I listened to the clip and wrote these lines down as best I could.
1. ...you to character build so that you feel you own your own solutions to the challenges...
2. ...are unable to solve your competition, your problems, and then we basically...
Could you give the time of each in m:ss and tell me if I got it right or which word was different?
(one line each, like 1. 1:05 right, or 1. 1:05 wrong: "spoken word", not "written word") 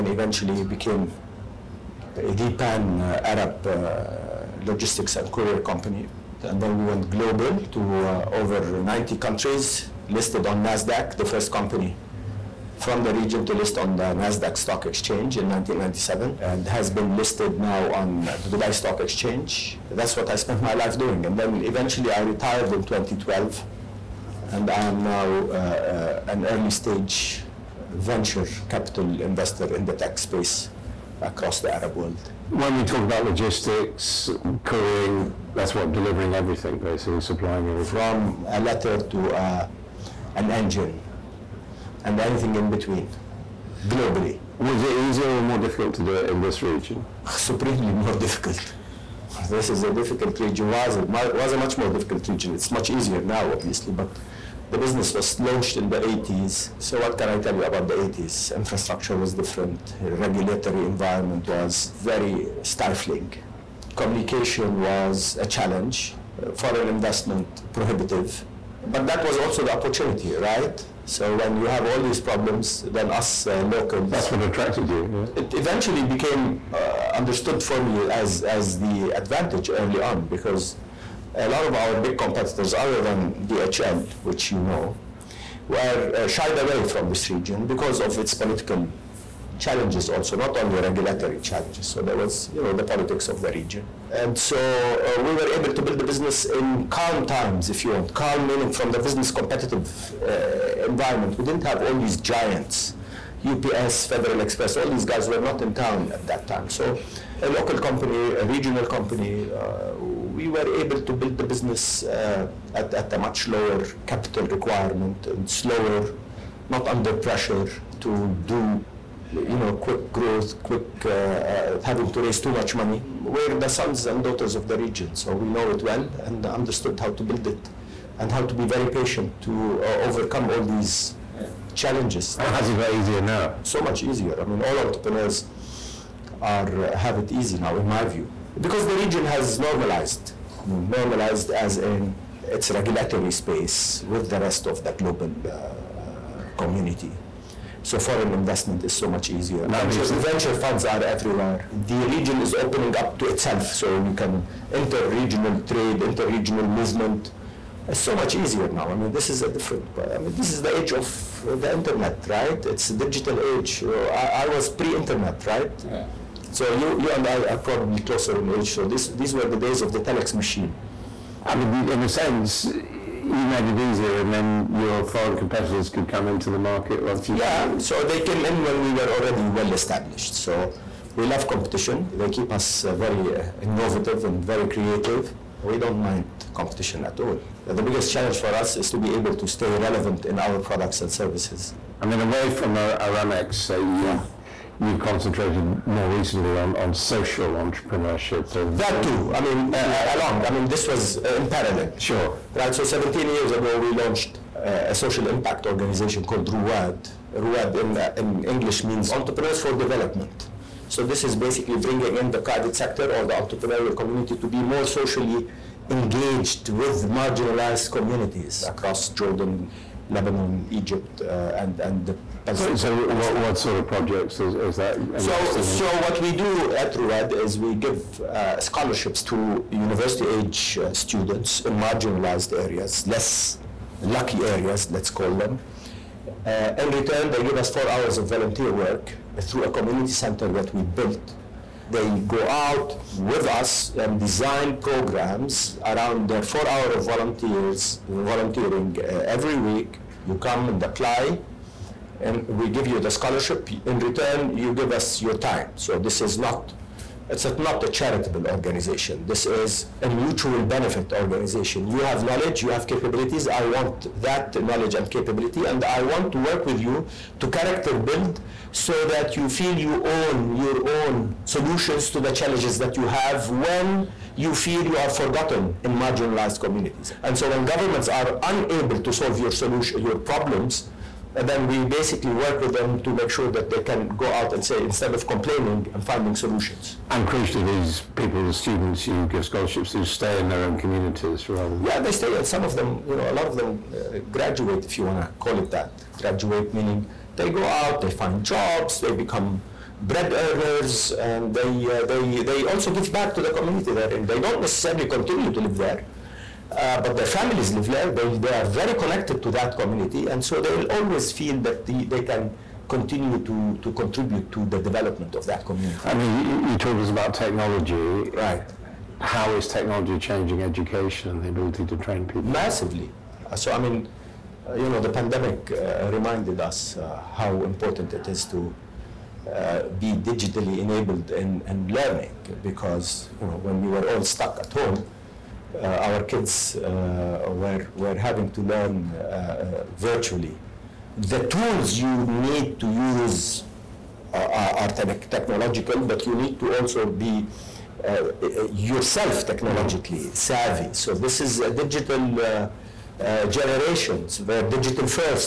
1. 4:26 right
2. 4:38 wrong: "solution", not "competition".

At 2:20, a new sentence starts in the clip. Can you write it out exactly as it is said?
I mean, normalized as in its regulatory space with the rest of the global uh, community.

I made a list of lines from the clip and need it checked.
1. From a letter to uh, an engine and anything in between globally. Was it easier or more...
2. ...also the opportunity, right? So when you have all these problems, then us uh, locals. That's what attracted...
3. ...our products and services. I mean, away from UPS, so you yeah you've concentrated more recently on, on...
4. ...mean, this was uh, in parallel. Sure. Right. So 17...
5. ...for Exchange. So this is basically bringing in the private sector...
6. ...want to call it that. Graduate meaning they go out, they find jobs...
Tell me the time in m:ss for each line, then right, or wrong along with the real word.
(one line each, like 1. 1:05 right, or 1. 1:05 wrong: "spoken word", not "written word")
1. 0:37 right
2. 1:09 right
3. 3:10 wrong: "Aramex", not "UPS"
4. 3:20 right
5. 3:29 wrong: "Development", not "Exchange"
6. 4:55 right.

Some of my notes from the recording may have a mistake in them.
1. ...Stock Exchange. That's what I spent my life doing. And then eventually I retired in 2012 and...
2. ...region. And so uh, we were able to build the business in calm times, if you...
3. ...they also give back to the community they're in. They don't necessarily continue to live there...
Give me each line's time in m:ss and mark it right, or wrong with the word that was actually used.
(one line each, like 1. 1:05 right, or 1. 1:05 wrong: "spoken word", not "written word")
1. 0:18 right
2. 1:33 right
3. 5:02 right.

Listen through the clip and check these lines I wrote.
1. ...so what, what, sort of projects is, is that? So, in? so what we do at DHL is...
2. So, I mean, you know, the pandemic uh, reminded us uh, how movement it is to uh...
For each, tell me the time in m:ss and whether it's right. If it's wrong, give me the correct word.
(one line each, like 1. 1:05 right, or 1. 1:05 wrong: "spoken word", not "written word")
1. 3:42 wrong: "Ruwad", not "DHL"
2. 5:23 wrong: "important", not "movement".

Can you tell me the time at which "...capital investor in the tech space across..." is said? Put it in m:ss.
0:28.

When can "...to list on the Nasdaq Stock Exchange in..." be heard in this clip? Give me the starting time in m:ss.
0:13.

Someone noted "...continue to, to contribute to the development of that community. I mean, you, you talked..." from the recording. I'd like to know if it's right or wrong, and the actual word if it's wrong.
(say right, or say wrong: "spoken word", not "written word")
right.